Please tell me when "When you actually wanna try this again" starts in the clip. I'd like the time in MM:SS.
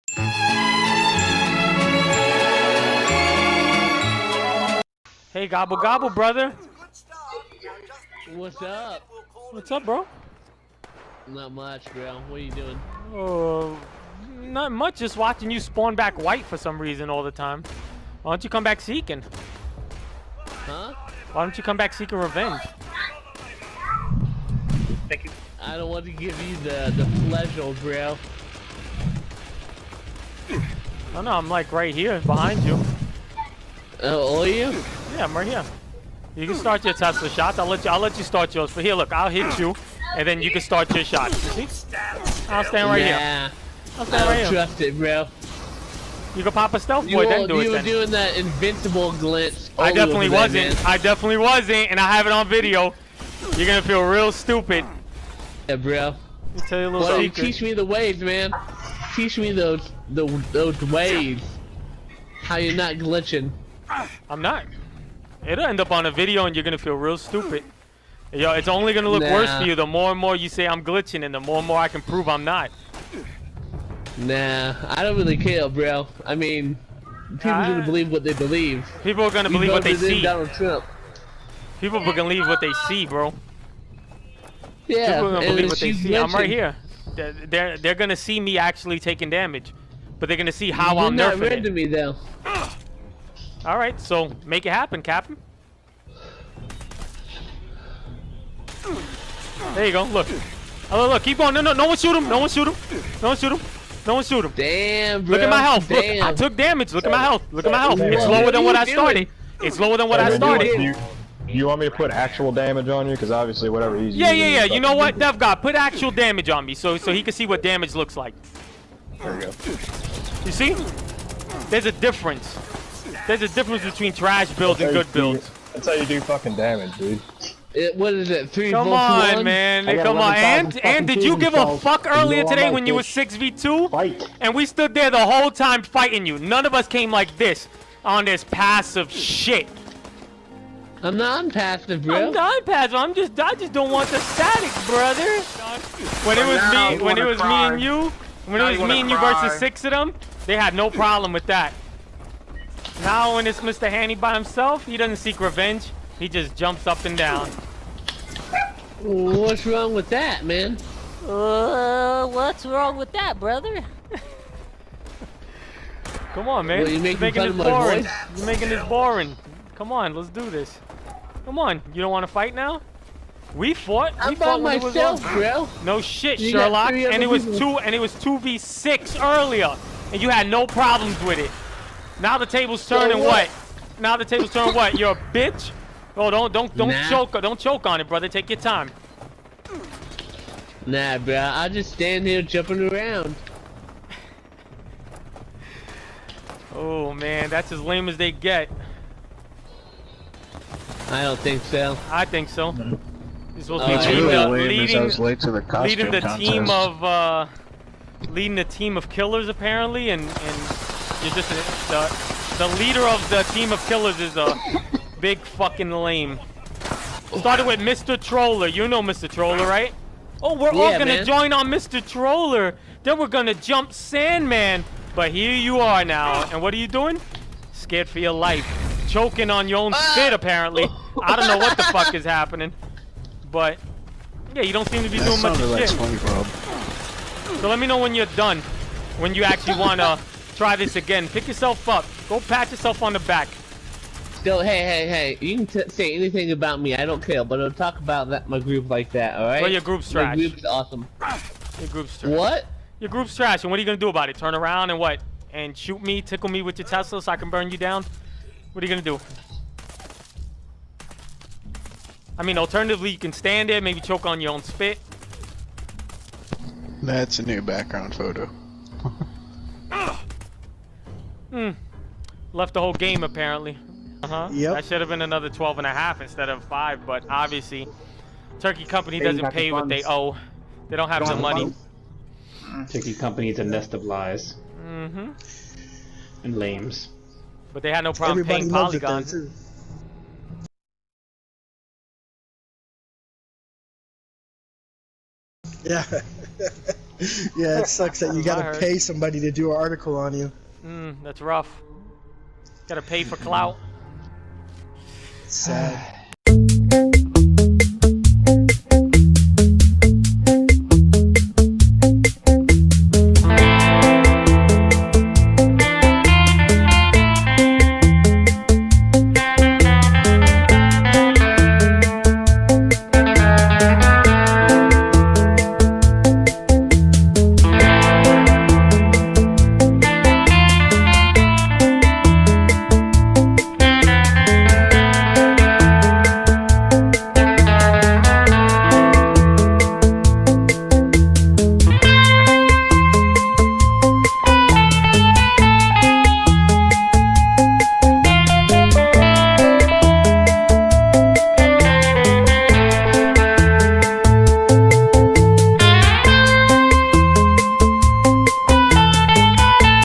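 03:59.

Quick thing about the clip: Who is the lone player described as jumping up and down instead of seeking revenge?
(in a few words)
Mr. Handy.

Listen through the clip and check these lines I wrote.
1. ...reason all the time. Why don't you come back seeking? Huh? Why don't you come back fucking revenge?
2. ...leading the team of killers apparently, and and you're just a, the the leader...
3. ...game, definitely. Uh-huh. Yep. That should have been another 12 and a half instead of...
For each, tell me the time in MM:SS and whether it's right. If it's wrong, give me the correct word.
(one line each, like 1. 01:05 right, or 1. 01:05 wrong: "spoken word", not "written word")
1. 00:16 wrong: "seeking", not "fucking"
2. 03:28 right
3. 04:32 wrong: "apparently", not "definitely".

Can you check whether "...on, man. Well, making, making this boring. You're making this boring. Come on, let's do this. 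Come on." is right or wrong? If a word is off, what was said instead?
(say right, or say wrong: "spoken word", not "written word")
right.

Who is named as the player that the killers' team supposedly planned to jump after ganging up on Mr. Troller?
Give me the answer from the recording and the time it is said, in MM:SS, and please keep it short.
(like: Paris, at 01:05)
Sandman, at 03:43.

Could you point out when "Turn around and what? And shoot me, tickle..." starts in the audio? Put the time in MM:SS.
04:14.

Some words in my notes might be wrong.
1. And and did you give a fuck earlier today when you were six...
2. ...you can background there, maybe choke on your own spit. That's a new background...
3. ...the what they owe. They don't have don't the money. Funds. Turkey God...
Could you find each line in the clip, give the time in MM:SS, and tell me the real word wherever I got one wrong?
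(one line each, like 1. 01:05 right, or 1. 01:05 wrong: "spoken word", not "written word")
1. 02:10 right
2. 04:23 wrong: "stand", not "background"
3. 04:39 wrong: "Company", not "God".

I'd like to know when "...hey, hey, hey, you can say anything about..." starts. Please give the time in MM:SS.
04:04.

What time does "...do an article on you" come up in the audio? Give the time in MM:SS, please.
04:59.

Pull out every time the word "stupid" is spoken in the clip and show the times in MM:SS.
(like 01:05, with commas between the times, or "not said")
00:54, 01:07.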